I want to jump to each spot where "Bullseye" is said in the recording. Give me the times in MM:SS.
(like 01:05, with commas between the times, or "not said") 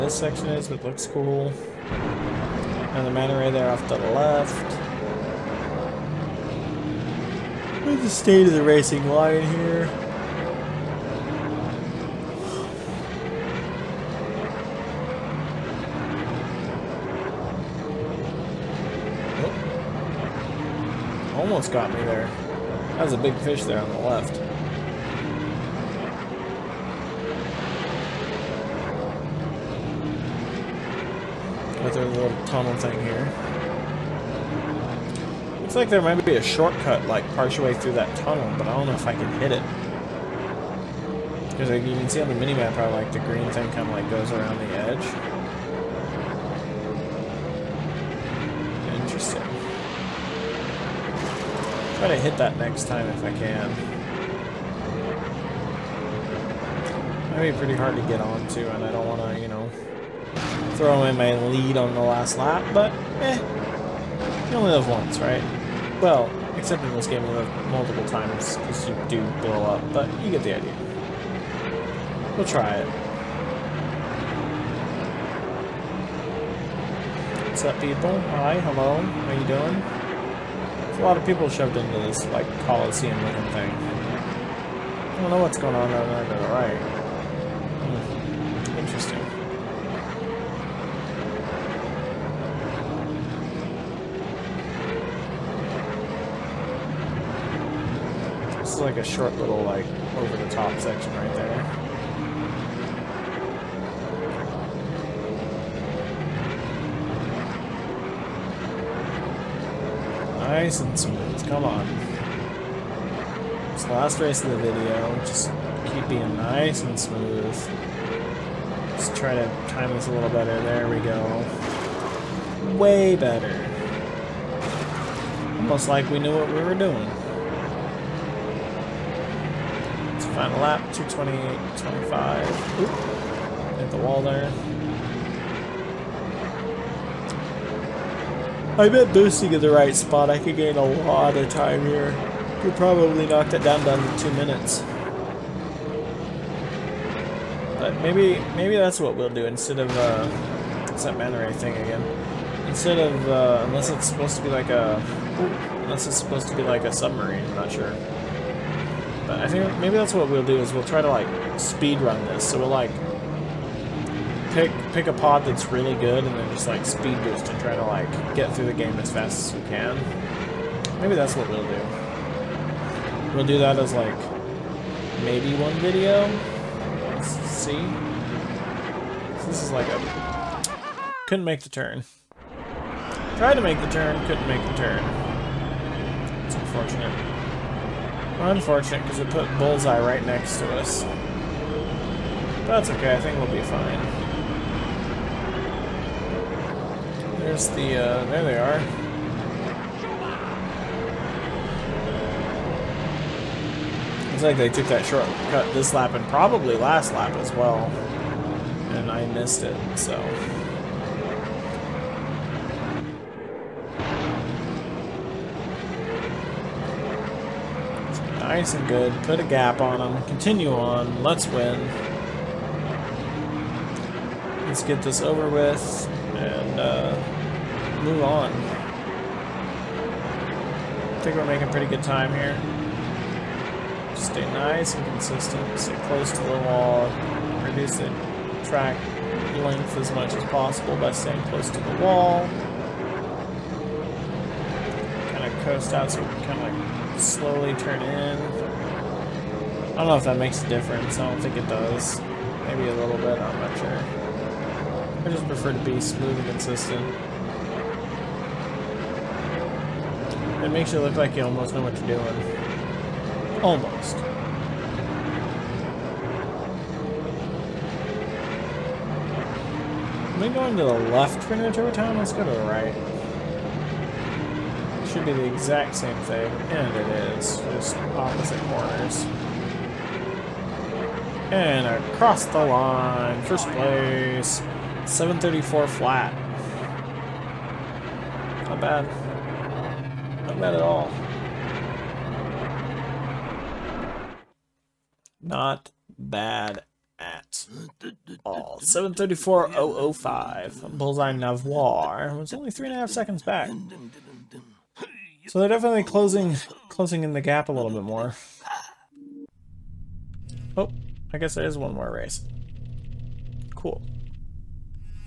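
03:09, 05:00.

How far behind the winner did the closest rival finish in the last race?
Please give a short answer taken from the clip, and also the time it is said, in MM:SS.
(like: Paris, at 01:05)
3.5 seconds, at 05:02.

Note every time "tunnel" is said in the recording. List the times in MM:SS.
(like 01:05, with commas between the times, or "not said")
00:32, 00:38.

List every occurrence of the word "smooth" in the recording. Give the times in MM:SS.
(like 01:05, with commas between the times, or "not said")
01:50, 01:56, 04:16.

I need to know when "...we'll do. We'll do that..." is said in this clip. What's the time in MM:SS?
02:51.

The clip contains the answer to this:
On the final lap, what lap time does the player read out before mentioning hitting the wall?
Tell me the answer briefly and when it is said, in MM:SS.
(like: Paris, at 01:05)
2:20.25, at 02:10.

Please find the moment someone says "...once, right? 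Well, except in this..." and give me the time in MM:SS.
01:04.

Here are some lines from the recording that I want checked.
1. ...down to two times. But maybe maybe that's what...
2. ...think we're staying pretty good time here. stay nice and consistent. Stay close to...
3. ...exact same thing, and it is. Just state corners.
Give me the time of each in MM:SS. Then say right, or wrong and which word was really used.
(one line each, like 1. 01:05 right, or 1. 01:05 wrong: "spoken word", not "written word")
1. 02:23 wrong: "minutes", not "times"
2. 03:51 wrong: "making", not "staying"
3. 04:35 wrong: "opposite", not "state".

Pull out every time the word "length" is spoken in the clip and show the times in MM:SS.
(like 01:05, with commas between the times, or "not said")
03:59.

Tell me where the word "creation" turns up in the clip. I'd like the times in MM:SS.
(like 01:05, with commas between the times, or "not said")
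not said.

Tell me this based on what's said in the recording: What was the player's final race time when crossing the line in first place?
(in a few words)
7:34.005.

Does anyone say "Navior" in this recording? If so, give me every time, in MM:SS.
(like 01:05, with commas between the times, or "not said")
05:01.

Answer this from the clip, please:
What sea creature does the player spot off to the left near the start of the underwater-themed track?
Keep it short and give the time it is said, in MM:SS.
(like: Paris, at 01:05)
Manta ray, at 00:03.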